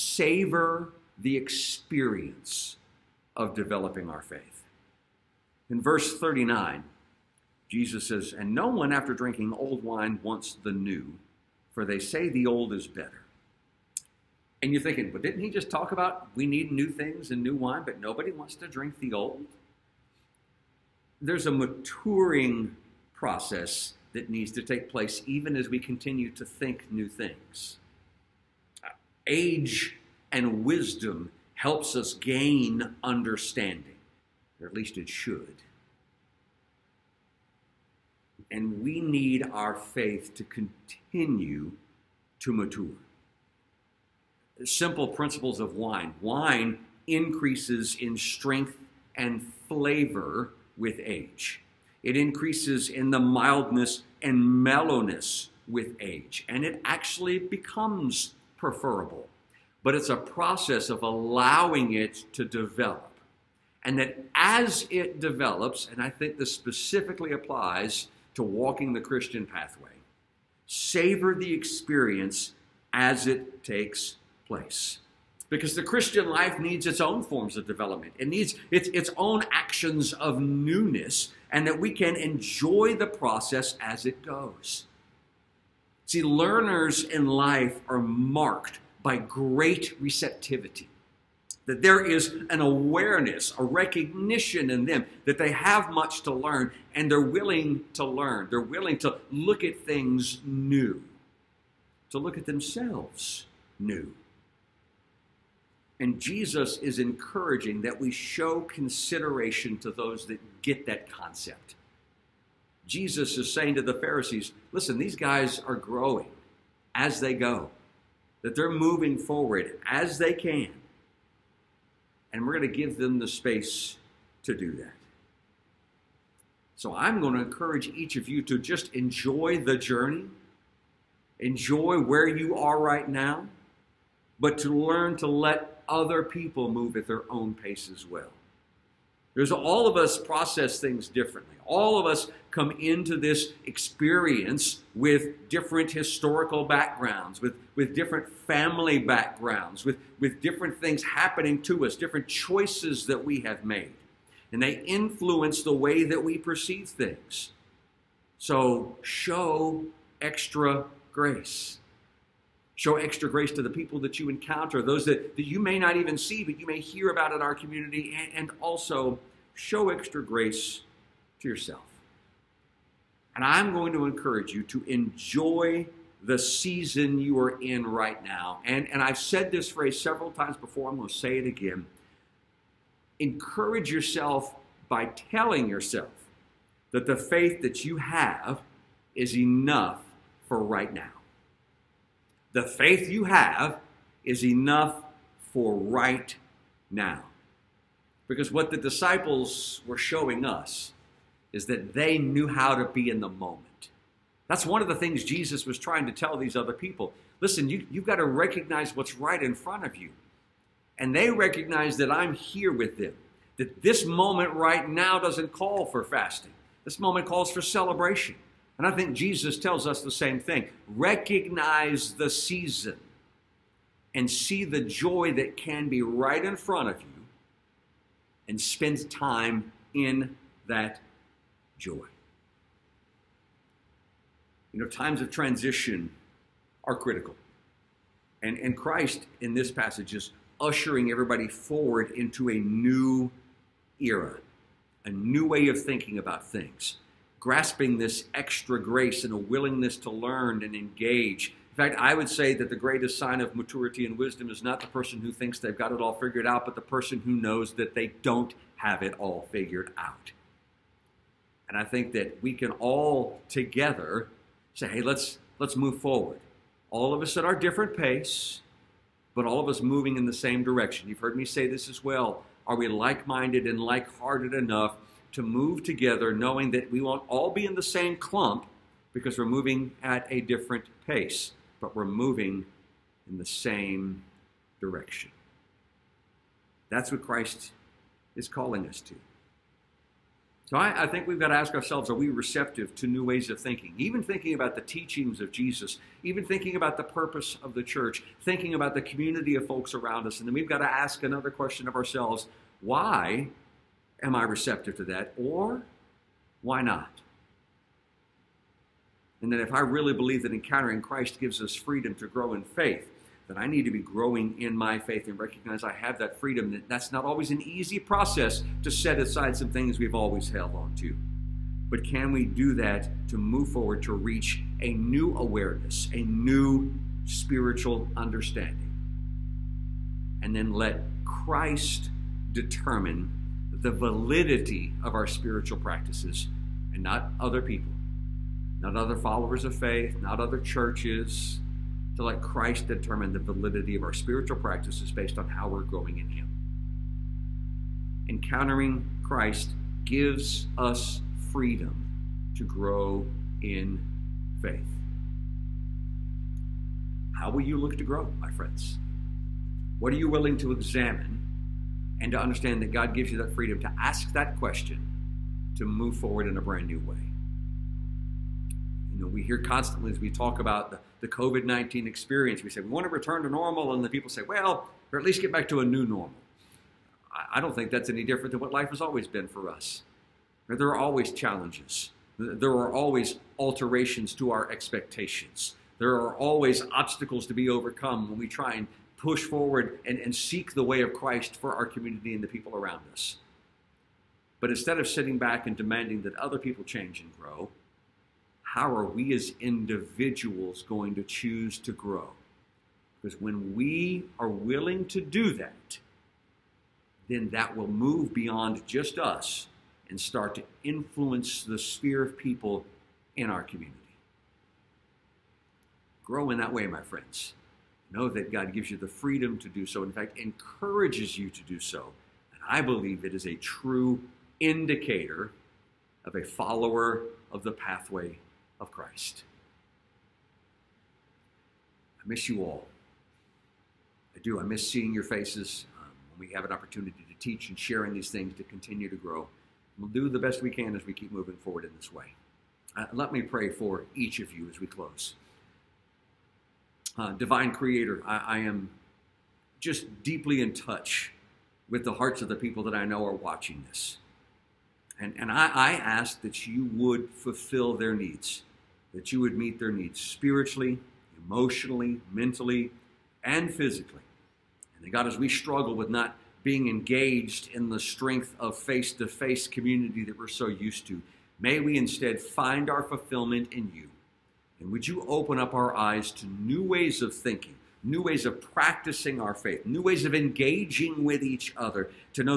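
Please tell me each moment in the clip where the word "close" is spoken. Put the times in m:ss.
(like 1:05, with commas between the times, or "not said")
7:24.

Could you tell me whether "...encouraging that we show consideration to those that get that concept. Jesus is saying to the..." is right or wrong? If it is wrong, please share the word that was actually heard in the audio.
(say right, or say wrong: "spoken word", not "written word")
right.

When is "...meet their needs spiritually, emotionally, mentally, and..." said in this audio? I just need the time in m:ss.
7:39.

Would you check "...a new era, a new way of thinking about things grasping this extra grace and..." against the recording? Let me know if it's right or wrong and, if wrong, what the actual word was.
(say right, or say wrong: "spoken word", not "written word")
right.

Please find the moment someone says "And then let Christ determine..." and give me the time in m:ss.
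5:30.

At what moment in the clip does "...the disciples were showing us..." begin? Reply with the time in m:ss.
3:18.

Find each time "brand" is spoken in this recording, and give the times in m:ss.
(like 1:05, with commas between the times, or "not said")
6:06.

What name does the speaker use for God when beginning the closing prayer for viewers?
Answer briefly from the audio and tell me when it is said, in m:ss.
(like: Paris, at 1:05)
divine creator, at 7:27.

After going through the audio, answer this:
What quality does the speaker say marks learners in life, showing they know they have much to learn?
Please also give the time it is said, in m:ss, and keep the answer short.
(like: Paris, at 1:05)
great receptivity, at 1:29.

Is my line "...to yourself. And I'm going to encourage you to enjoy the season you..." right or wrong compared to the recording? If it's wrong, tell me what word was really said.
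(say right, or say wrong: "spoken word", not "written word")
right.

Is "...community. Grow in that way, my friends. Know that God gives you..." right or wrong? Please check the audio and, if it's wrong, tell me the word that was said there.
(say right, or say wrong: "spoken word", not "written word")
right.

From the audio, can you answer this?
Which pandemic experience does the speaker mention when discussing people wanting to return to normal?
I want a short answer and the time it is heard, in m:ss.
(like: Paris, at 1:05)
COVID-19, at 6:11.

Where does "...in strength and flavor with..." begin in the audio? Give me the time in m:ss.
0:47.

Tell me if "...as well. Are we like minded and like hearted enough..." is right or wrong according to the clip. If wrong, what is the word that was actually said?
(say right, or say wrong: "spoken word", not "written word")
right.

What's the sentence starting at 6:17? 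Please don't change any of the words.
I, I don't think that's any different than what life has always been for us.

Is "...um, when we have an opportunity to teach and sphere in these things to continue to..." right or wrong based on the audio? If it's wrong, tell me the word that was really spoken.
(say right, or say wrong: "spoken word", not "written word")
wrong: "share", not "sphere".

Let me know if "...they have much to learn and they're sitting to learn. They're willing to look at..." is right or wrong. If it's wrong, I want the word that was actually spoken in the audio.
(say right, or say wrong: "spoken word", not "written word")
wrong: "willing", not "sitting".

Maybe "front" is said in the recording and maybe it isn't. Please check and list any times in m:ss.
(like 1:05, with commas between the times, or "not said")
3:29, 3:46.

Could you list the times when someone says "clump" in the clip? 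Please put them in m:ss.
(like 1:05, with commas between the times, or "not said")
4:38.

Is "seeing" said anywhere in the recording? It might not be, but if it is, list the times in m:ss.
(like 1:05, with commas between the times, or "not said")
7:14.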